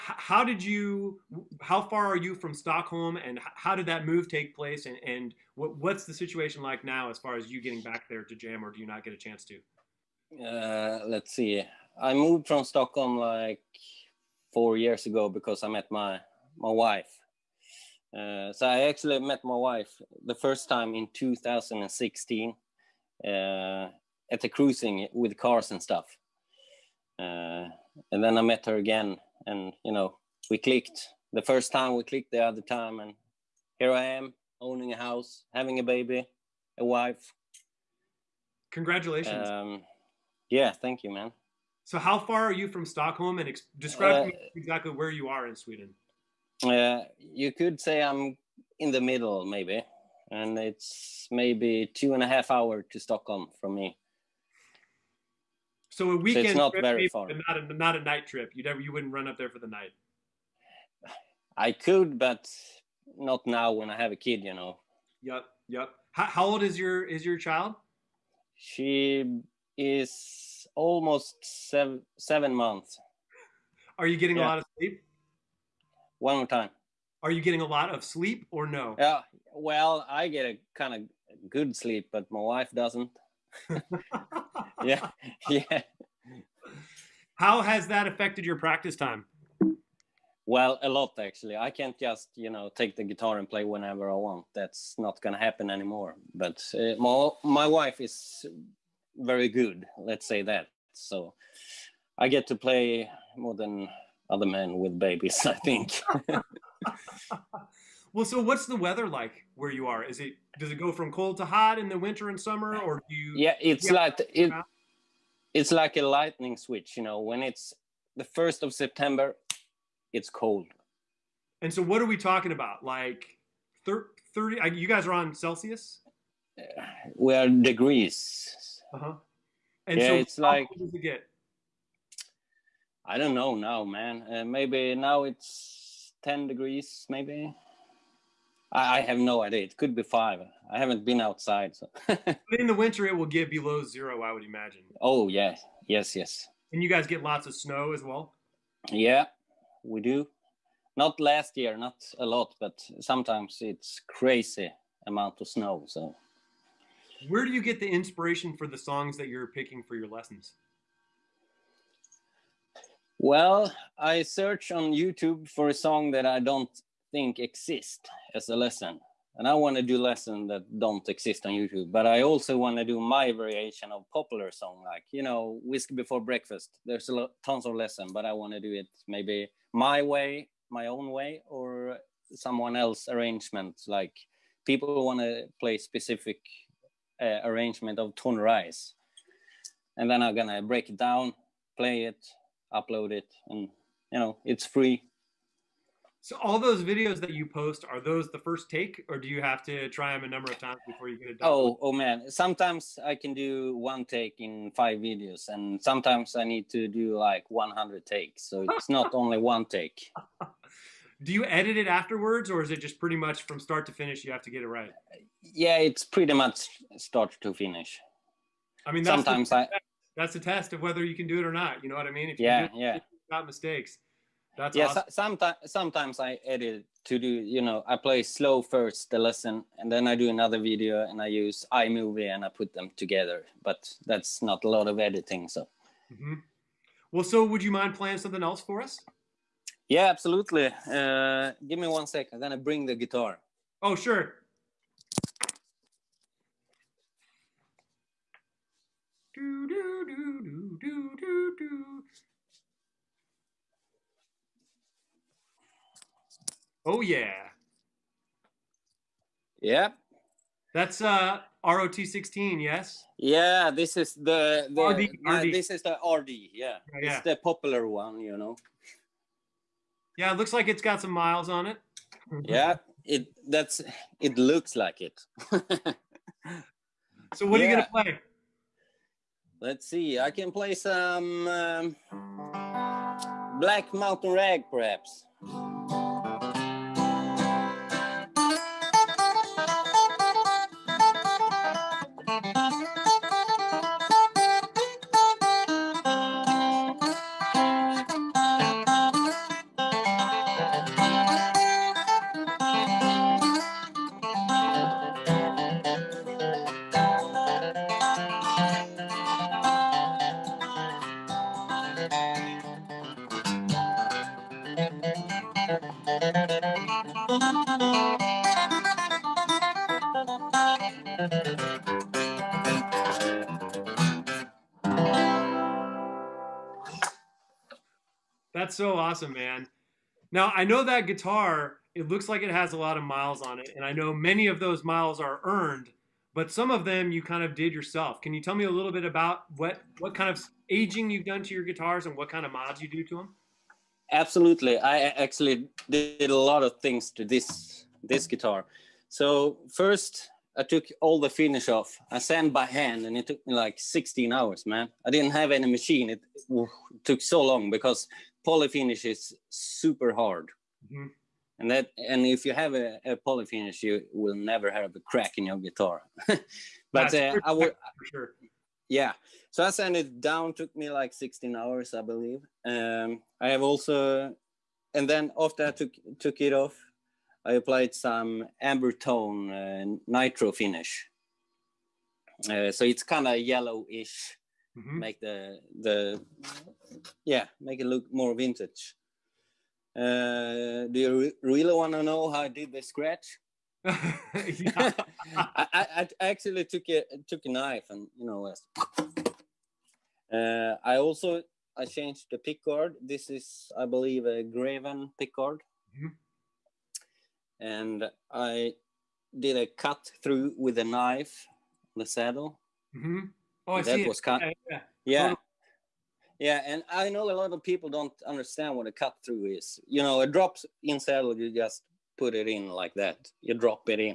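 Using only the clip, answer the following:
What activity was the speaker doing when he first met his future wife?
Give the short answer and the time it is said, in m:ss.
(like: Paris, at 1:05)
cruising with cars, at 0:24.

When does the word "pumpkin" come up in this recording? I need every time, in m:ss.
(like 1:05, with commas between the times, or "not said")
not said.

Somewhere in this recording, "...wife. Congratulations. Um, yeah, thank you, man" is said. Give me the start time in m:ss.
0:36.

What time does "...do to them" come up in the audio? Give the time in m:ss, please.
5:42.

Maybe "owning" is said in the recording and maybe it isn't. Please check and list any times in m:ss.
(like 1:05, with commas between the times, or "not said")
0:34.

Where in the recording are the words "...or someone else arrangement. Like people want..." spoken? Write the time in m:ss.
3:01.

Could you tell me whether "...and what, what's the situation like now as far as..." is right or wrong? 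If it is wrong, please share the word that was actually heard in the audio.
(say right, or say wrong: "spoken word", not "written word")
right.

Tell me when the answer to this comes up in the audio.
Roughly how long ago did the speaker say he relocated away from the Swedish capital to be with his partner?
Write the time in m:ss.
0:14.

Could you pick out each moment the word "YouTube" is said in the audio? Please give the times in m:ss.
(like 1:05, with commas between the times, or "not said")
2:44, 2:51.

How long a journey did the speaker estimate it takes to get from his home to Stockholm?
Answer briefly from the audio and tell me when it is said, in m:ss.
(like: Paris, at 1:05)
2.5 hours, at 0:51.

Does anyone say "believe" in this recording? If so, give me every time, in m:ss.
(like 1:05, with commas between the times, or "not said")
6:12, 6:43.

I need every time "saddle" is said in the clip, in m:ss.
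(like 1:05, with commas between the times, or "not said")
6:52, 7:00.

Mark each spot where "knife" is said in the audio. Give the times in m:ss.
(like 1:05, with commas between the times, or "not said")
6:37, 6:50.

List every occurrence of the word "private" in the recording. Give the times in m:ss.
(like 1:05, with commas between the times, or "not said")
not said.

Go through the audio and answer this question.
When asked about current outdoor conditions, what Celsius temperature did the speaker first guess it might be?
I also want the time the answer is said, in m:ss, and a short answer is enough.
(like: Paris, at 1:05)
10 degrees, at 2:16.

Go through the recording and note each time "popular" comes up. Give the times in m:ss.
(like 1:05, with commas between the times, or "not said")
2:54, 4:27.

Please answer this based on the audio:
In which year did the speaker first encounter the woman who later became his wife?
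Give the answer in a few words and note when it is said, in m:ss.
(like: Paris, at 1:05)
2016, at 0:21.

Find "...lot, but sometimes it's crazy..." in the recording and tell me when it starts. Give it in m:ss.
2:32.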